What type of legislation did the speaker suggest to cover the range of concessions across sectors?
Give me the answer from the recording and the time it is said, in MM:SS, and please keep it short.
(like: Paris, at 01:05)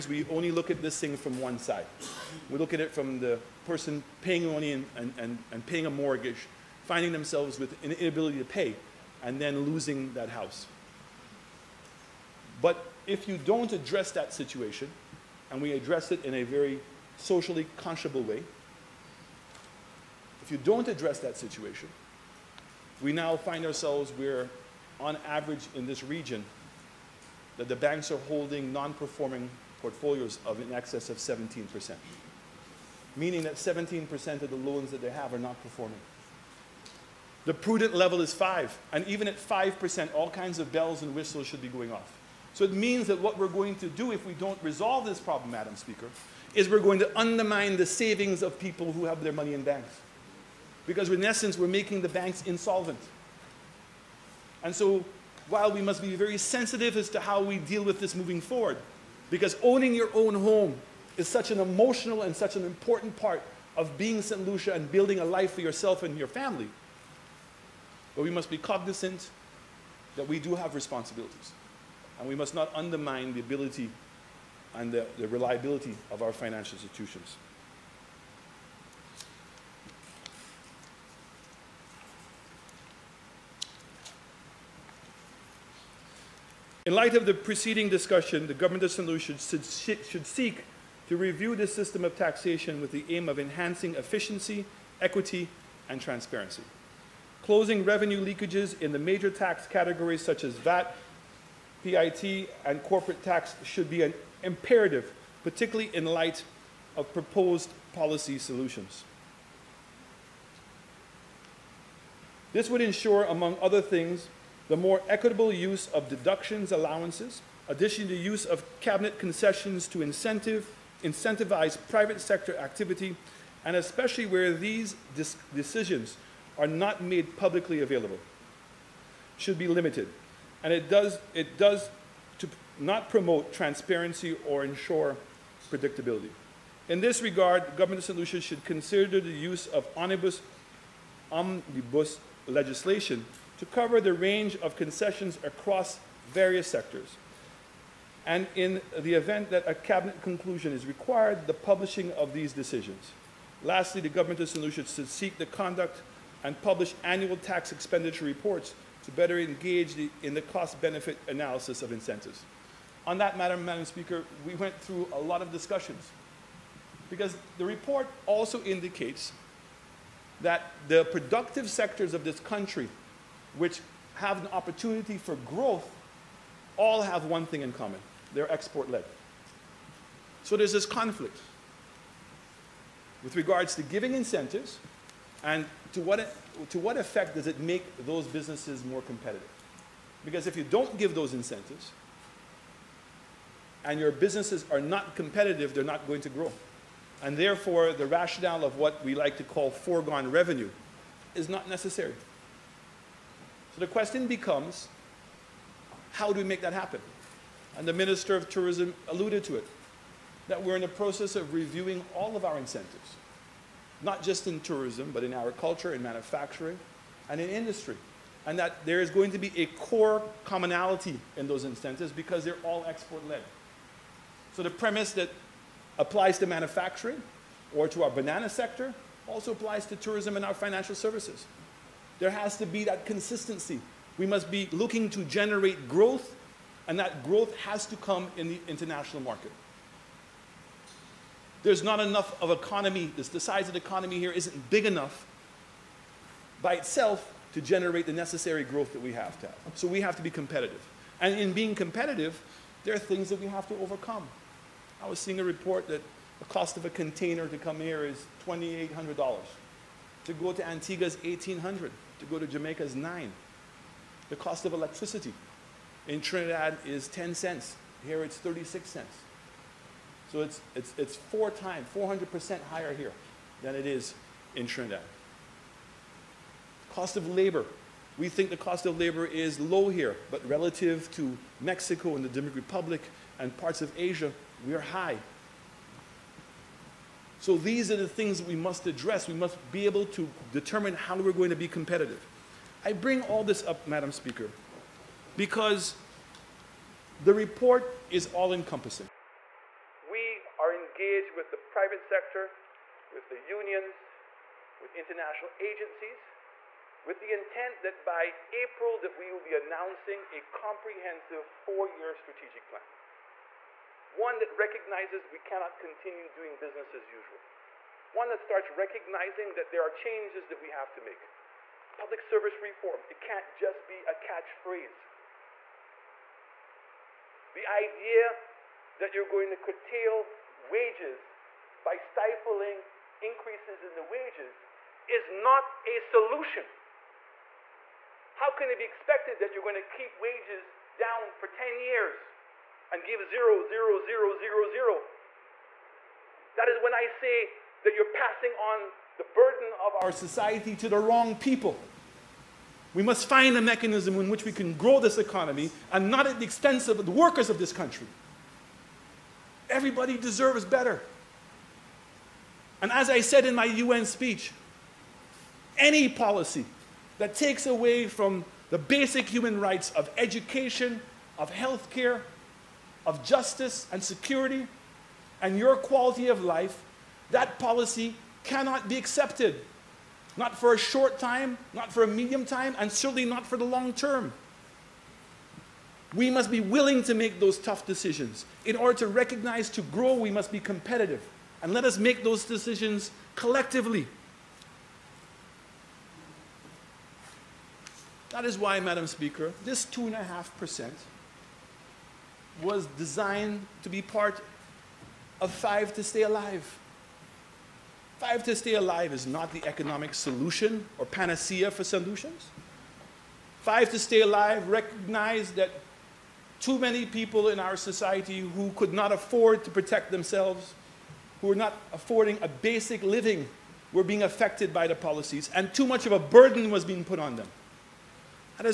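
Omnibus legislation, at 02:21.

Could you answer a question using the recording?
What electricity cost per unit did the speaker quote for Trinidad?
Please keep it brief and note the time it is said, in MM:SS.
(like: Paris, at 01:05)
10 cents, at 04:27.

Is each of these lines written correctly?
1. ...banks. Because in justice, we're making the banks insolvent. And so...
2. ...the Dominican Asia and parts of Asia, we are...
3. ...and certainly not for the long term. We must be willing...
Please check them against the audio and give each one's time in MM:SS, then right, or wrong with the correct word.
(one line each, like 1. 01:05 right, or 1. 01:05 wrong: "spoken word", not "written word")
1. 00:49 wrong: "essence", not "justice"
2. 04:42 wrong: "Republic", not "Asia"
3. 06:22 right.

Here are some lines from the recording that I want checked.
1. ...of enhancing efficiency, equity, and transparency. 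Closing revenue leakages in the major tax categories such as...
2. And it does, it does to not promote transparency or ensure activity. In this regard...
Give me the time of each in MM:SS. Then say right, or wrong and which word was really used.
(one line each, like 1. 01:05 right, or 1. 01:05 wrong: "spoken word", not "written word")
1. 01:33 right
2. 02:10 wrong: "predictability", not "activity".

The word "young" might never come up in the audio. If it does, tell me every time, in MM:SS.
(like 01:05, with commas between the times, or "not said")
not said.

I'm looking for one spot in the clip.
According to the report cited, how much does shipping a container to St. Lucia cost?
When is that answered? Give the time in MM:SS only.
04:18.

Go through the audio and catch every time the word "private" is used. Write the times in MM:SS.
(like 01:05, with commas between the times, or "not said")
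02:01, 05:01.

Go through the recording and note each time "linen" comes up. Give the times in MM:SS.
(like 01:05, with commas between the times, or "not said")
not said.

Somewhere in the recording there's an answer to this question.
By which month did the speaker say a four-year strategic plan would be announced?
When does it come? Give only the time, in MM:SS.
05:08.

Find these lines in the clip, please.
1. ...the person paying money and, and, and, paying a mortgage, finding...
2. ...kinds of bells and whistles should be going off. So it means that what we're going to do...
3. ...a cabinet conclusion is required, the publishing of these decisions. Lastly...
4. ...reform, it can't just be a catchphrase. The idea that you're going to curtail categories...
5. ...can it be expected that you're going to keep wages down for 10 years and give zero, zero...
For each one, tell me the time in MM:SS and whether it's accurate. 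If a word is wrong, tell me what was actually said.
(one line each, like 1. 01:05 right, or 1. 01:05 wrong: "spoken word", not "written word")
1. 00:03 right
2. 00:40 right
3. 02:29 right
4. 05:22 wrong: "wages", not "categories"
5. 05:38 right.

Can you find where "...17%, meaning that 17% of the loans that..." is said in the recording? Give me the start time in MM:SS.
00:31.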